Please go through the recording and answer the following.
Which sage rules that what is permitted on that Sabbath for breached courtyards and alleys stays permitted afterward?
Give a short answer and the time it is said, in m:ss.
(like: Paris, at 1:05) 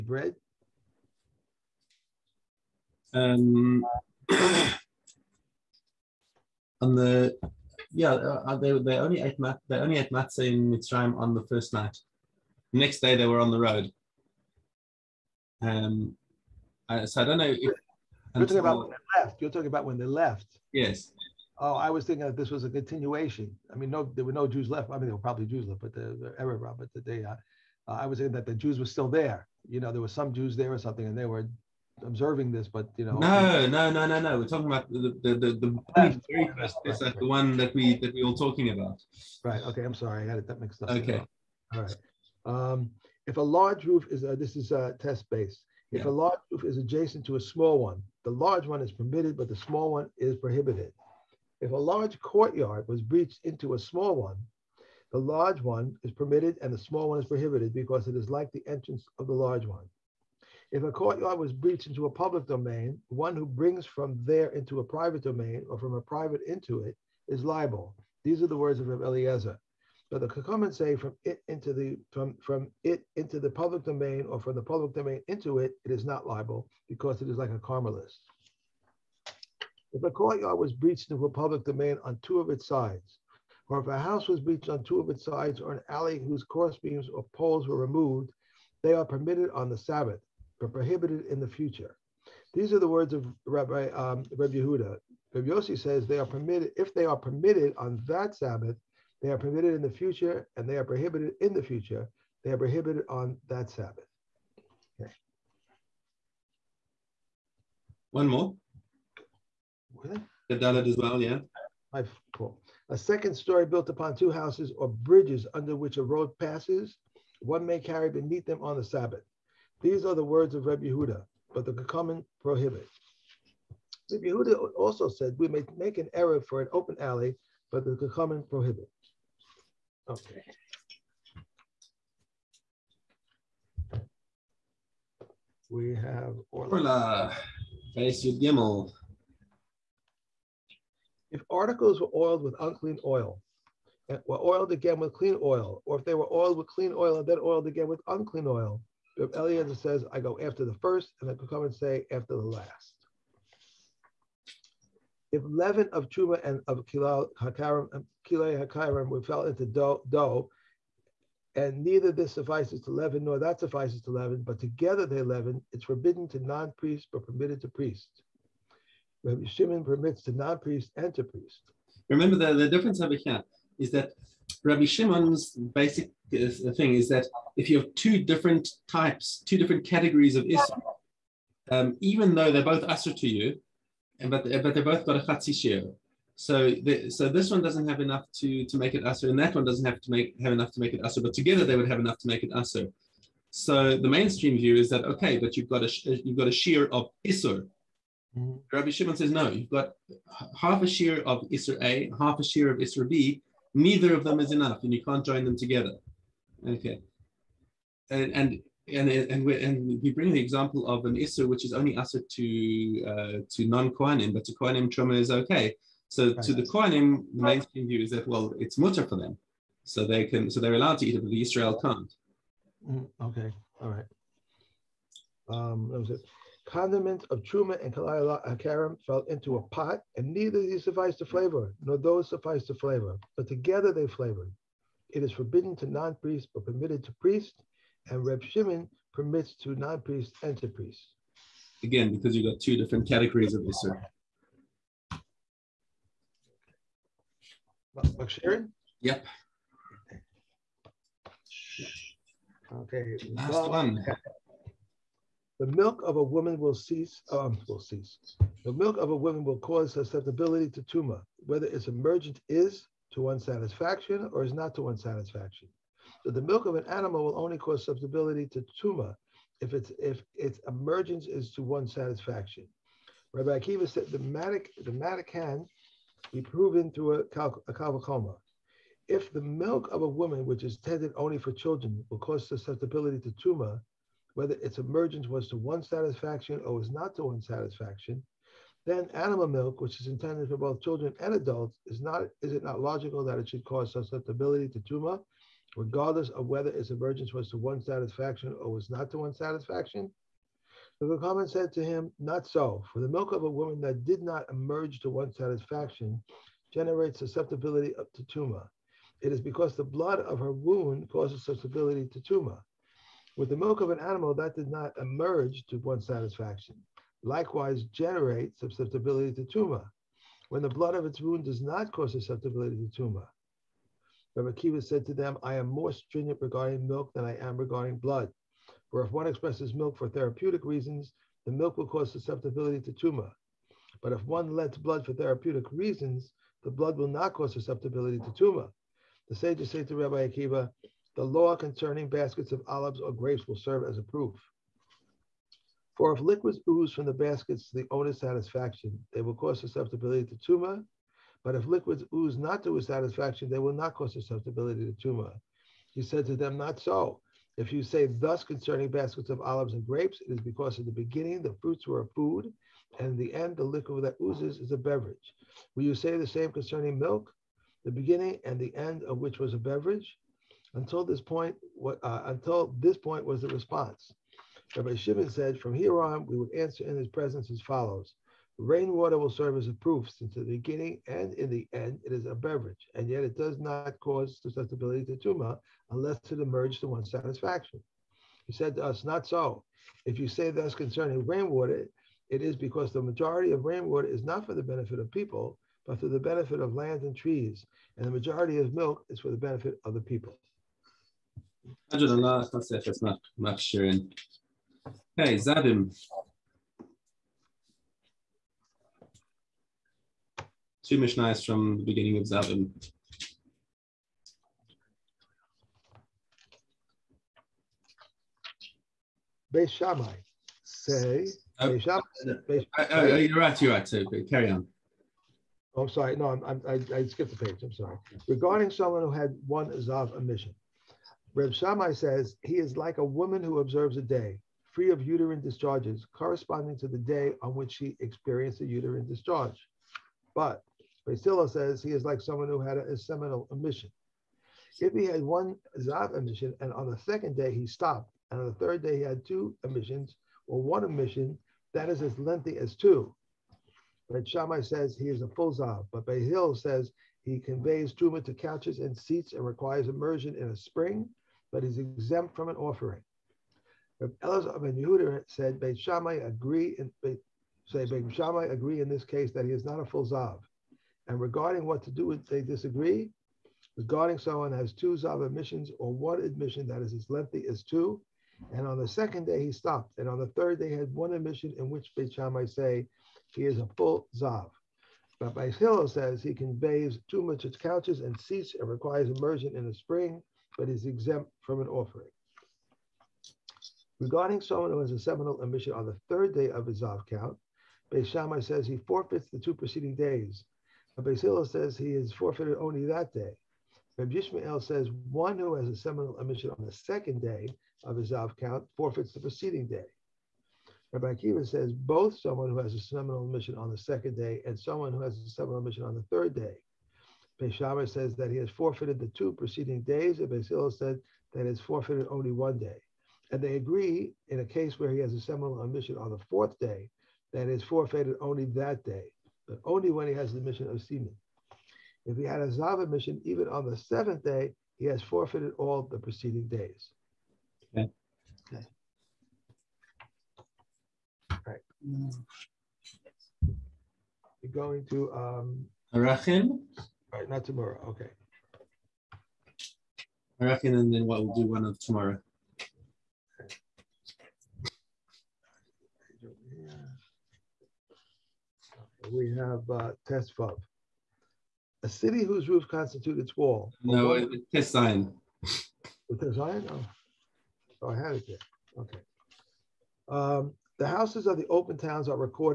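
Rabbi Yossi, at 1:35.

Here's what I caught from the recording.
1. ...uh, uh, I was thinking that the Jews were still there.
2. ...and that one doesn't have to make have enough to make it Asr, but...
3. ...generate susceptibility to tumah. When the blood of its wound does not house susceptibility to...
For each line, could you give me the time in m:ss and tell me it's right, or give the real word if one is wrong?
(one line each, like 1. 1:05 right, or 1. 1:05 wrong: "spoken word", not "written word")
1. 0:27 right
2. 3:09 right
3. 5:17 wrong: "cause", not "house".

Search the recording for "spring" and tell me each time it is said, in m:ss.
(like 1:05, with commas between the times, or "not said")
7:40, 8:09.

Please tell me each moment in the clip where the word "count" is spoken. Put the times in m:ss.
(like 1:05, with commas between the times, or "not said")
8:17, 8:28.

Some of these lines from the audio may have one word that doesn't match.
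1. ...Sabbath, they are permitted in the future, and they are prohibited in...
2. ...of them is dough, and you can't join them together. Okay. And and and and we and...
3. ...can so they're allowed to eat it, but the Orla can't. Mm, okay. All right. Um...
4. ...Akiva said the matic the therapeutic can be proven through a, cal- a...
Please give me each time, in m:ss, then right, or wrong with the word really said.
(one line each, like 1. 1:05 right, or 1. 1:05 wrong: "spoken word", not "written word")
1. 1:38 right
2. 3:24 wrong: "enough", not "dough"
3. 3:40 wrong: "Israel", not "Orla"
4. 4:33 wrong: "matic", not "therapeutic".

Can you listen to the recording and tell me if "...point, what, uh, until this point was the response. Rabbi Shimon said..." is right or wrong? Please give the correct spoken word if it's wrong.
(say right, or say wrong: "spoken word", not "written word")
right.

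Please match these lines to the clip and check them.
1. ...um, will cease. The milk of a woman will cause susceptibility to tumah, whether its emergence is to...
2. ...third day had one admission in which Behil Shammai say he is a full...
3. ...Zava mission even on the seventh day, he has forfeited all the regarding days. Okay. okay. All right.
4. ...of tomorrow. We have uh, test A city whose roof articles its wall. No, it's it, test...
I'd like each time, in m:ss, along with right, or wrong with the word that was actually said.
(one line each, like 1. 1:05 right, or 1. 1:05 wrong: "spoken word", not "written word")
1. 4:17 right
2. 8:00 wrong: "Beit", not "Behil"
3. 8:52 wrong: "preceding", not "regarding"
4. 9:11 wrong: "constitutes", not "articles".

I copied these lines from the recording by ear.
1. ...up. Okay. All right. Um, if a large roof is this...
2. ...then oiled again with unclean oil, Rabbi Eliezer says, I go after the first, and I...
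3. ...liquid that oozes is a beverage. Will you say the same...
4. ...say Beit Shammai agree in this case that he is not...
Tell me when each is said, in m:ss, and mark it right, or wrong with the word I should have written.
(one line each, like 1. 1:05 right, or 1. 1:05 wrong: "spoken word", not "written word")
1. 0:40 right
2. 2:27 right
3. 6:03 right
4. 7:47 right.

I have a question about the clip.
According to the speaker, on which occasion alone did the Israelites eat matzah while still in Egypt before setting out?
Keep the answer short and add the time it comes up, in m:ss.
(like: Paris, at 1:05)
The first night, at 0:11.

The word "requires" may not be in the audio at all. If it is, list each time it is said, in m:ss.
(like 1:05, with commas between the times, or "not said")
7:39, 8:08.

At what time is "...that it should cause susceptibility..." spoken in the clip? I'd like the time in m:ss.
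4:53.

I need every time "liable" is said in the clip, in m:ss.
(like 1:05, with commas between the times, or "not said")
1:07, 1:16.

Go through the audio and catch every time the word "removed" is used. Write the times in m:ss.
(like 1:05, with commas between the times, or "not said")
1:27.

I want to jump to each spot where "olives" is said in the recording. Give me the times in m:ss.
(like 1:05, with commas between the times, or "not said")
5:42, 5:59.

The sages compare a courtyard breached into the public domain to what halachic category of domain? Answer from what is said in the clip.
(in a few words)
Karmelis.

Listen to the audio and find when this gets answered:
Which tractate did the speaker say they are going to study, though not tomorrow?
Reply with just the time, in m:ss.
9:05.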